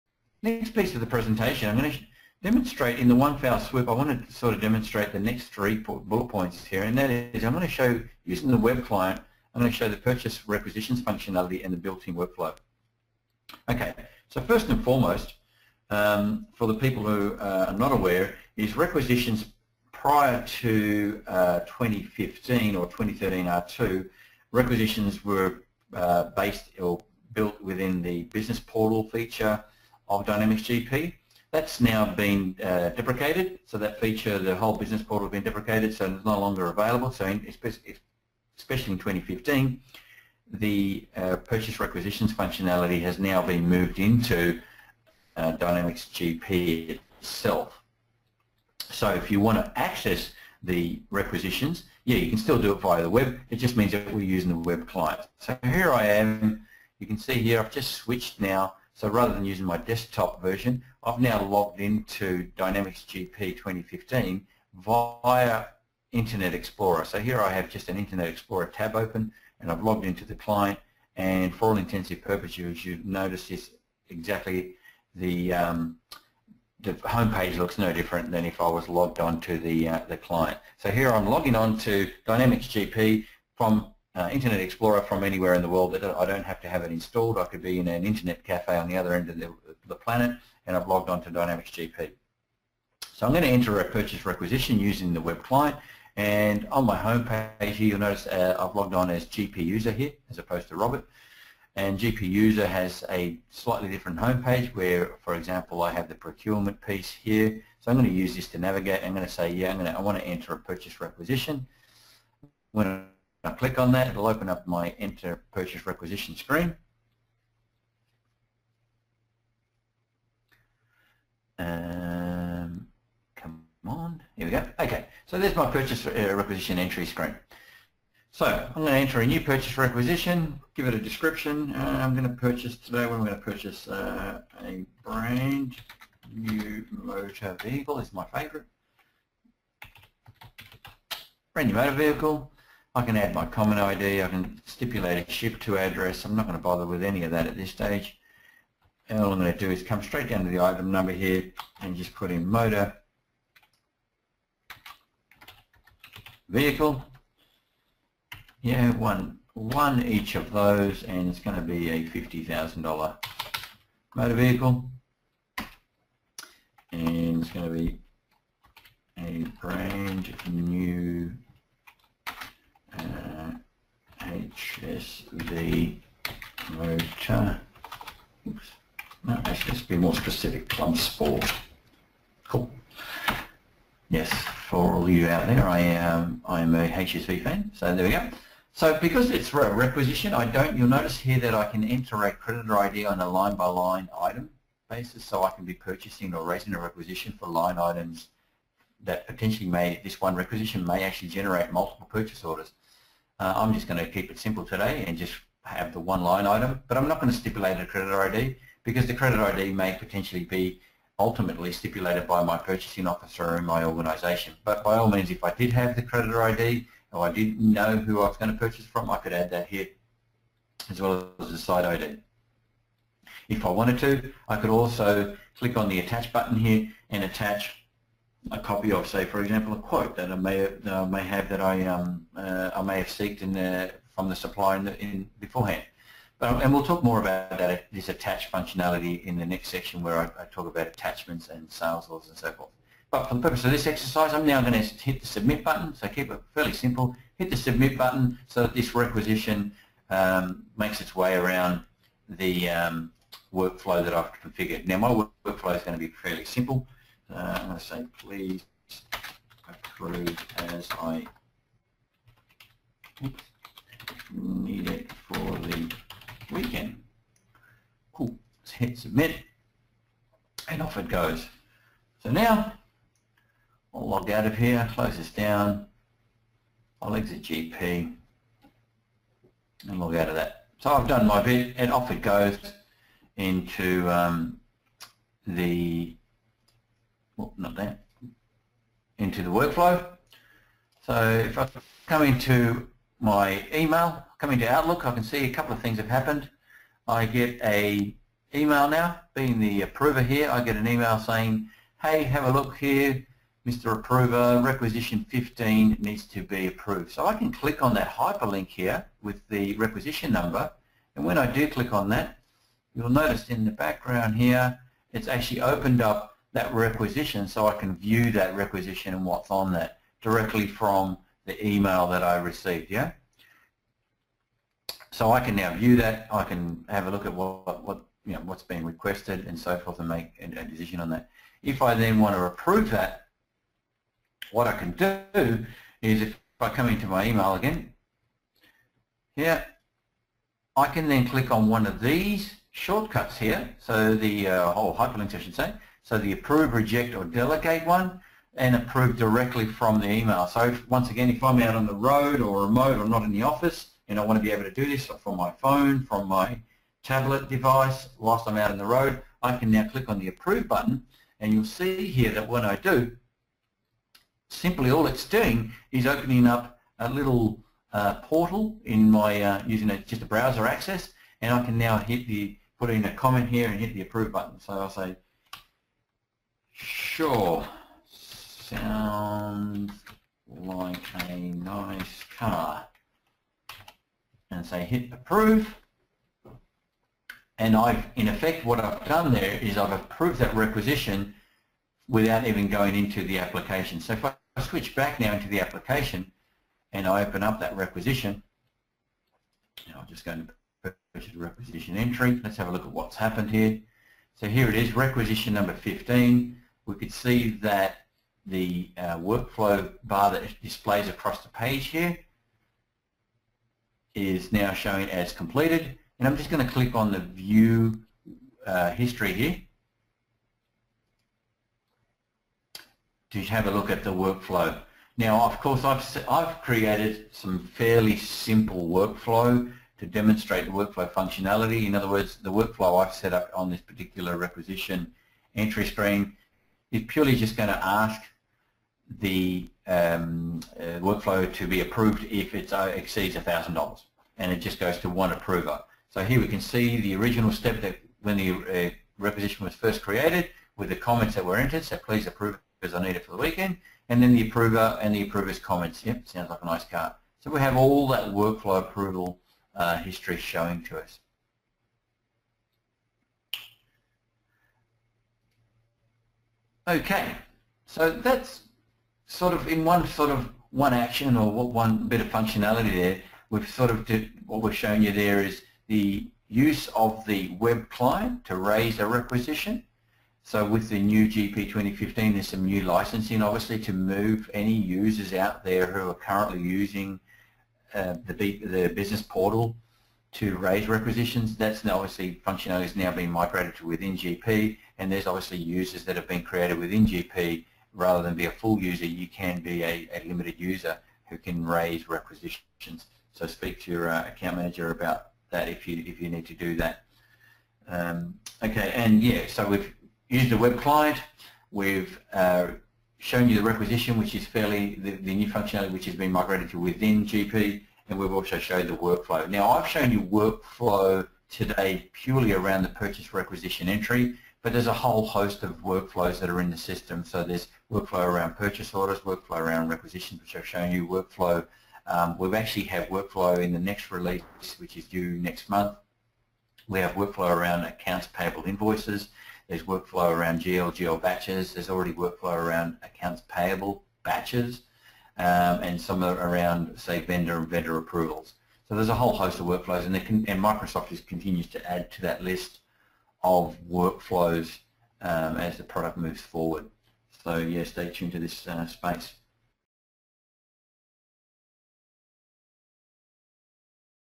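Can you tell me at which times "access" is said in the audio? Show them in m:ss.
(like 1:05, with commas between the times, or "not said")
0:49, 6:10.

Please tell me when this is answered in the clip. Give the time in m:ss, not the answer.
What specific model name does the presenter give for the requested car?
3:00.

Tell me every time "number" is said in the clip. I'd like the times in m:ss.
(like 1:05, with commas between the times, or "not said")
2:30, 5:10, 6:45.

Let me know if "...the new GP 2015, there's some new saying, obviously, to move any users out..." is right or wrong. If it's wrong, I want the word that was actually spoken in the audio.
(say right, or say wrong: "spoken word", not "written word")
wrong: "licensing", not "saying".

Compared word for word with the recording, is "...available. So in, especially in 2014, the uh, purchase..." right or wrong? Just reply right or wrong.
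wrong.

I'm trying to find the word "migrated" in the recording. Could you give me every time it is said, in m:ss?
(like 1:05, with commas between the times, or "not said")
8:13, 8:36.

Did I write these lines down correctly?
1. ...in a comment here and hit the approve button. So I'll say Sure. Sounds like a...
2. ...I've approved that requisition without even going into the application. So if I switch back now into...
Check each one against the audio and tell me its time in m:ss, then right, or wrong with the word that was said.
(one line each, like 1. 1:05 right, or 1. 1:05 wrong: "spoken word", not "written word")
1. 6:12 right
2. 6:29 right.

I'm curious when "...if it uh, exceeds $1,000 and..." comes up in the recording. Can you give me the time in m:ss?
7:22.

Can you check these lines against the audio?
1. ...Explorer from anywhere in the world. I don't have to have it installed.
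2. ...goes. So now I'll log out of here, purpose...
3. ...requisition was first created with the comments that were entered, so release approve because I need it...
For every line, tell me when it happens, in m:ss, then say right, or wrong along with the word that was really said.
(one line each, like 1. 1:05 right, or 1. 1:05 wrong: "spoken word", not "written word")
1. 1:24 right
2. 4:31 wrong: "close", not "purpose"
3. 7:29 wrong: "please", not "release".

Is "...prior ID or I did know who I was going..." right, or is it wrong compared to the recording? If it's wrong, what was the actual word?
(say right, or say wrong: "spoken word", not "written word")
wrong: "creditor", not "prior".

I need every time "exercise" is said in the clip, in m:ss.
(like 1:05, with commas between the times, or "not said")
4:03.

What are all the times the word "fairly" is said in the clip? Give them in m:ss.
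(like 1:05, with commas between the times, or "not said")
4:06, 4:16, 7:07, 8:34.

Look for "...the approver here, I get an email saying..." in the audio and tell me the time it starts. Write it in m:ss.
4:59.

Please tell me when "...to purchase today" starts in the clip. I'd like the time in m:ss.
2:12.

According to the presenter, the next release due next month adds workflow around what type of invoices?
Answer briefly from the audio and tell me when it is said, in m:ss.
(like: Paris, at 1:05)
accounts payable invoices, at 8:57.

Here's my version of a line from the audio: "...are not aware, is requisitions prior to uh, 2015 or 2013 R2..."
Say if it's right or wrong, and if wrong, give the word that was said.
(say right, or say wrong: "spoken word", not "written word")
right.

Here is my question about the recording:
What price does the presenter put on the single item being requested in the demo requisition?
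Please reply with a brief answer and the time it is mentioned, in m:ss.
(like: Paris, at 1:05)
$50,000, at 2:42.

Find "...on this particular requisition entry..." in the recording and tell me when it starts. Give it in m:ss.
7:13.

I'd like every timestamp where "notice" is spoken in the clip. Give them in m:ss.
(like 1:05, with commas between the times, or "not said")
1:13, 1:37, 3:10, 5:13.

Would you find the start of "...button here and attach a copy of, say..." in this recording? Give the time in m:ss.
3:46.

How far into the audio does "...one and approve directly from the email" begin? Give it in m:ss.
5:47.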